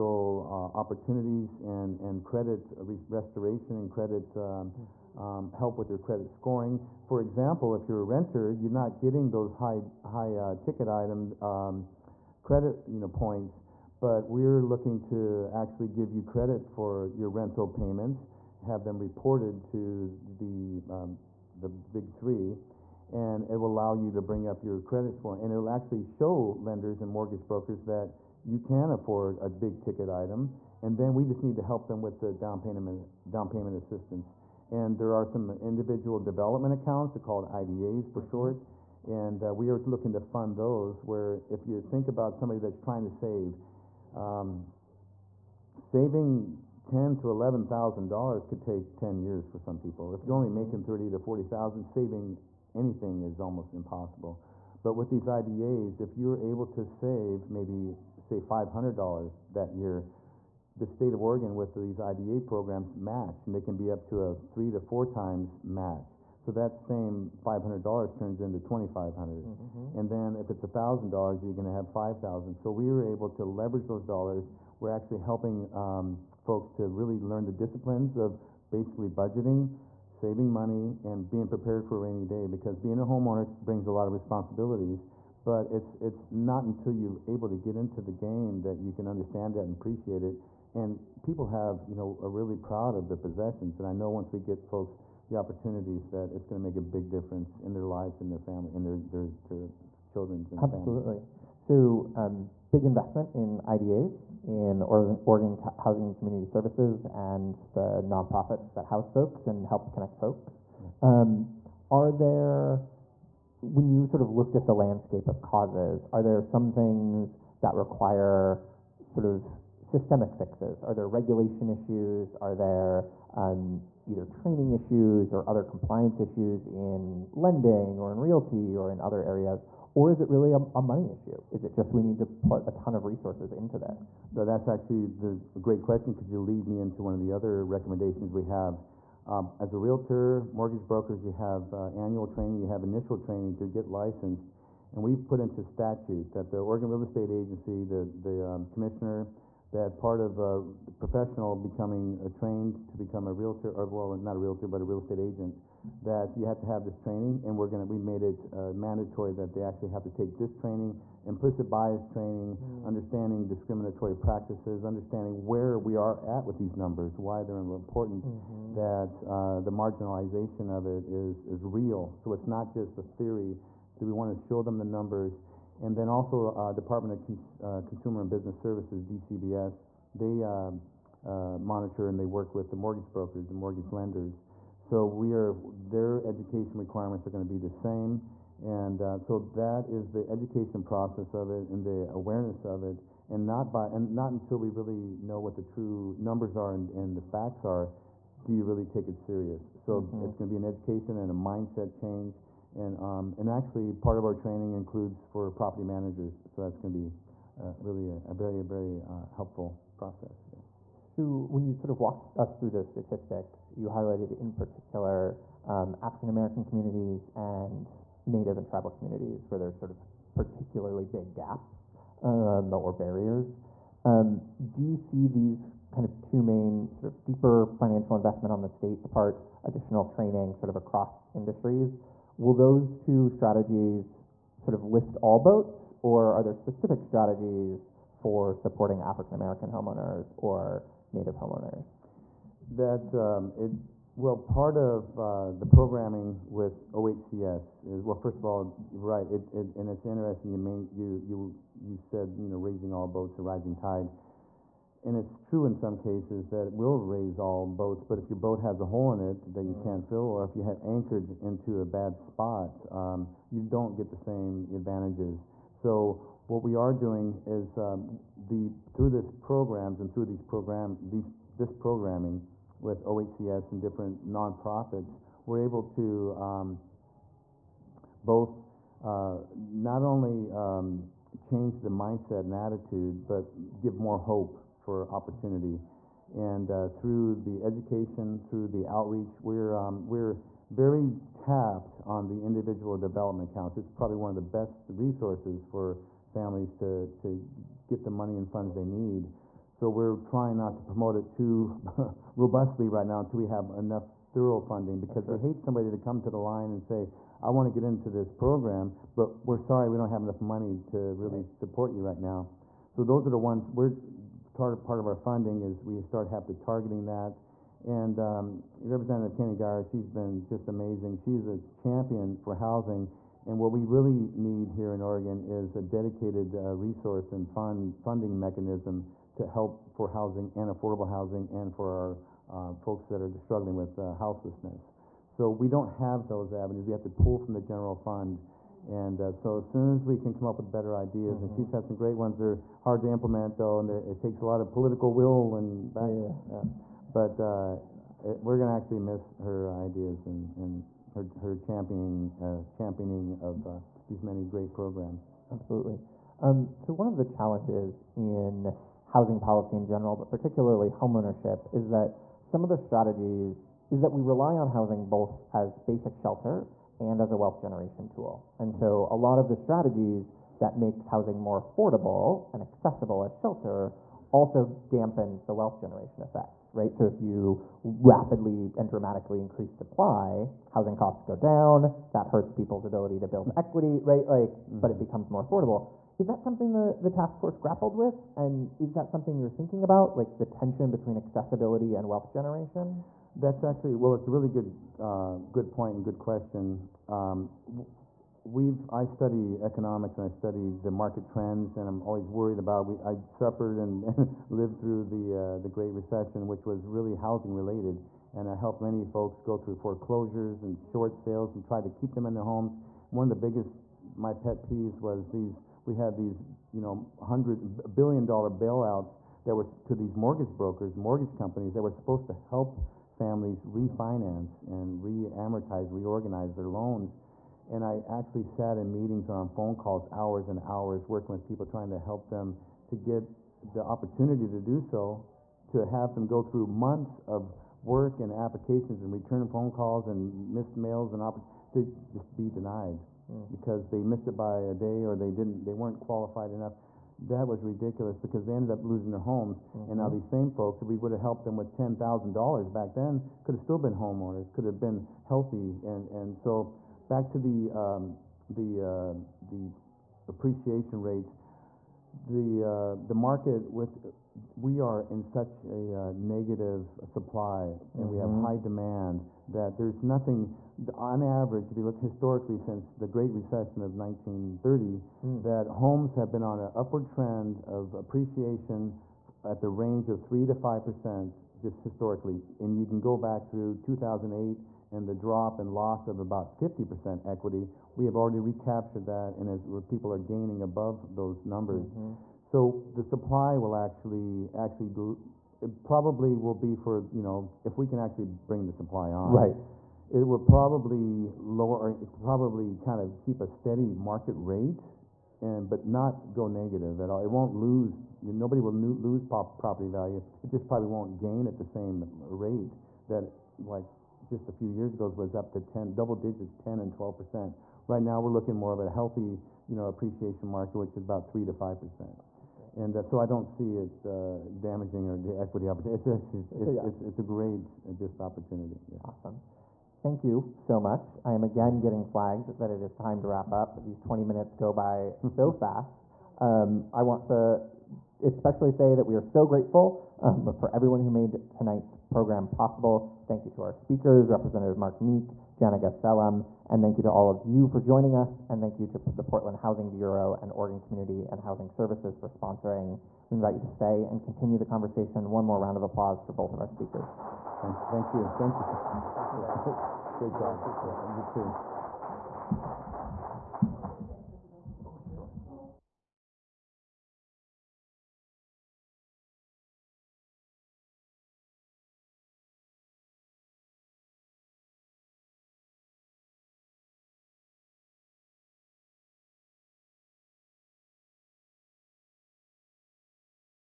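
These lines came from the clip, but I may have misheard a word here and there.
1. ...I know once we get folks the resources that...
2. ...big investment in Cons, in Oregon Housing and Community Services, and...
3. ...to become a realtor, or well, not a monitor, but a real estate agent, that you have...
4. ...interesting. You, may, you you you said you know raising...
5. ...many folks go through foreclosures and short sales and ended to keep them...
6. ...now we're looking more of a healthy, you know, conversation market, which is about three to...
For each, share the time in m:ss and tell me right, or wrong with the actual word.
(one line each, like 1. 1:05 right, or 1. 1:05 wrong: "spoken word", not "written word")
1. 1:33 wrong: "opportunities", not "resources"
2. 1:42 wrong: "IDAs", not "Cons"
3. 2:32 wrong: "realtor", not "monitor"
4. 4:10 right
5. 6:48 wrong: "tried", not "ended"
6. 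8:38 wrong: "appreciation", not "conversation".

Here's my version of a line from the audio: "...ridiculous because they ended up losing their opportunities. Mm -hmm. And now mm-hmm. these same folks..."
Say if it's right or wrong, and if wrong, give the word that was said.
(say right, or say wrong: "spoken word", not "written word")
wrong: "homes", not "opportunities".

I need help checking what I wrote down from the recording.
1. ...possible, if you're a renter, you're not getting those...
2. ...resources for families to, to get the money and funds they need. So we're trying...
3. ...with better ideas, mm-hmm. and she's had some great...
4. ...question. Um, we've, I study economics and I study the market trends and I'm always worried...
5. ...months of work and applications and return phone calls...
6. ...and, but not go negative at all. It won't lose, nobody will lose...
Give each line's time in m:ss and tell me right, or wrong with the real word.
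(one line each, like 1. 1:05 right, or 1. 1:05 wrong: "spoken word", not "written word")
1. 0:07 wrong: "example", not "possible"
2. 4:54 right
3. 5:40 right
4. 6:36 right
5. 7:16 right
6. 8:25 right.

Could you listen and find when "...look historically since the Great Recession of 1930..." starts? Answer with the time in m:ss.
7:51.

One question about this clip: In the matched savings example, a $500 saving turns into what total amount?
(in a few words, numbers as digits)
$2,500.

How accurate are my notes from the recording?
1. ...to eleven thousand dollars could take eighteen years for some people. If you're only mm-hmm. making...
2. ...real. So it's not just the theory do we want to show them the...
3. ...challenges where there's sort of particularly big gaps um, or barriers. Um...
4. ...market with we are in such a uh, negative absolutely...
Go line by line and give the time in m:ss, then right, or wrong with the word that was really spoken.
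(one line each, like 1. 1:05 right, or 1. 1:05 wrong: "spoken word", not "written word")
1. 0:47 wrong: "ten", not "eighteen"
2. 2:51 right
3. 3:38 wrong: "communities", not "challenges"
4. 7:43 wrong: "supply", not "absolutely".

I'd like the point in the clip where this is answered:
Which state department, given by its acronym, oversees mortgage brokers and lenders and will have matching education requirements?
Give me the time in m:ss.
2:59.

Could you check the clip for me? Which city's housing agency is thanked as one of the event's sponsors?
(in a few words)
Portland.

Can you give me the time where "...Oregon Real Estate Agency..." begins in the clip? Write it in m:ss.
2:26.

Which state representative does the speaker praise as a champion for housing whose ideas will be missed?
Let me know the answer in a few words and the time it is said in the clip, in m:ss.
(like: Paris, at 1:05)
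Keny-Guyer, at 5:19.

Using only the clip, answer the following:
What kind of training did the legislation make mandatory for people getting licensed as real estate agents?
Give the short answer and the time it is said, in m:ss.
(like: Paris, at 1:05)
implicit bias training, at 2:41.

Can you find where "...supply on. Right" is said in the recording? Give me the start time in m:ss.
8:18.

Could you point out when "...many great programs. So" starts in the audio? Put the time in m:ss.
5:54.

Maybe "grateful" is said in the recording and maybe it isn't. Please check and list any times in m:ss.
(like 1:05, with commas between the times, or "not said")
8:59.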